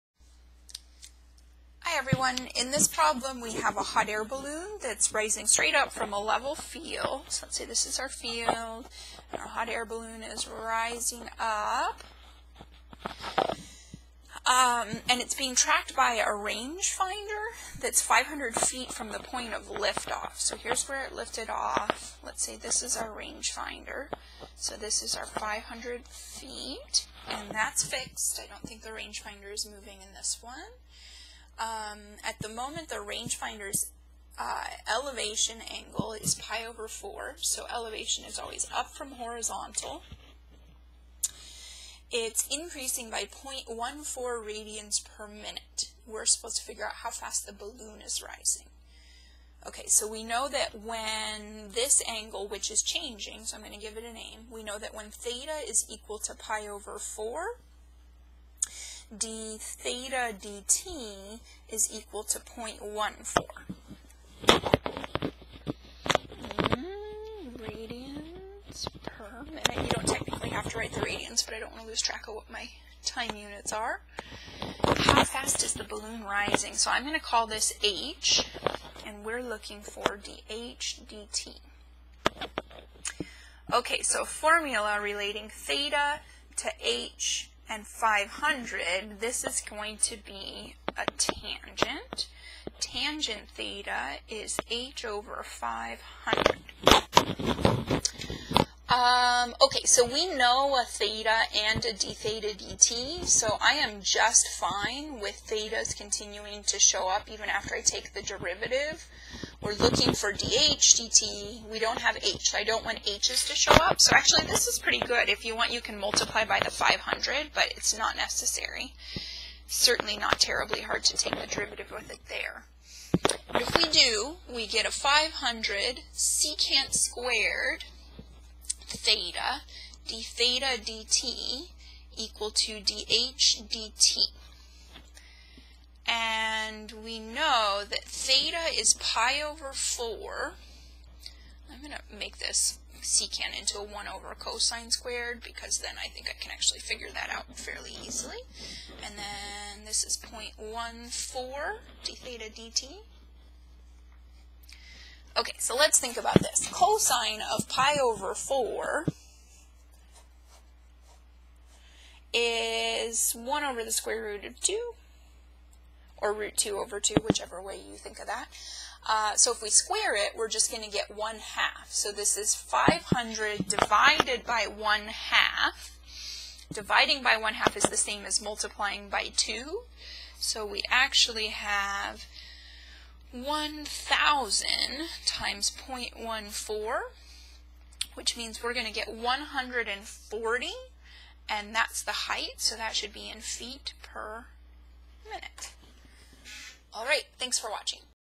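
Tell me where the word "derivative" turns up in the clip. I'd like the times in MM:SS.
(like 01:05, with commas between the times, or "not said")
01:48, 02:01.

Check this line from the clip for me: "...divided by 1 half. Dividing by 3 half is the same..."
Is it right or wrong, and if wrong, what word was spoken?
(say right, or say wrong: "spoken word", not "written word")
wrong: "1", not "3".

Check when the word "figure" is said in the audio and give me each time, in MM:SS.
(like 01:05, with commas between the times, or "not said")
00:46, 02:26.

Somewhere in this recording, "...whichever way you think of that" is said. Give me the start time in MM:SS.
02:47.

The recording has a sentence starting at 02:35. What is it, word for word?
Okay, so let's think about this.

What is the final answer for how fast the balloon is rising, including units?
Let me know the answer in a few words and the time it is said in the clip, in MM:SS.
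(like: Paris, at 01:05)
140 feet per minute, at 03:09.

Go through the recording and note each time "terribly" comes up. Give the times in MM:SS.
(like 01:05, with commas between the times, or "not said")
02:00.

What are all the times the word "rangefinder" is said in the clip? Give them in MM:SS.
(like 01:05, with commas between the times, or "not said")
00:16, 00:23, 00:28, 00:32.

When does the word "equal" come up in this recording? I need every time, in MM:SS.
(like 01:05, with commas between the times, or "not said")
00:55, 01:01, 02:12.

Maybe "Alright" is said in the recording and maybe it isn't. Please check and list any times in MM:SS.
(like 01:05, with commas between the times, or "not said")
03:16.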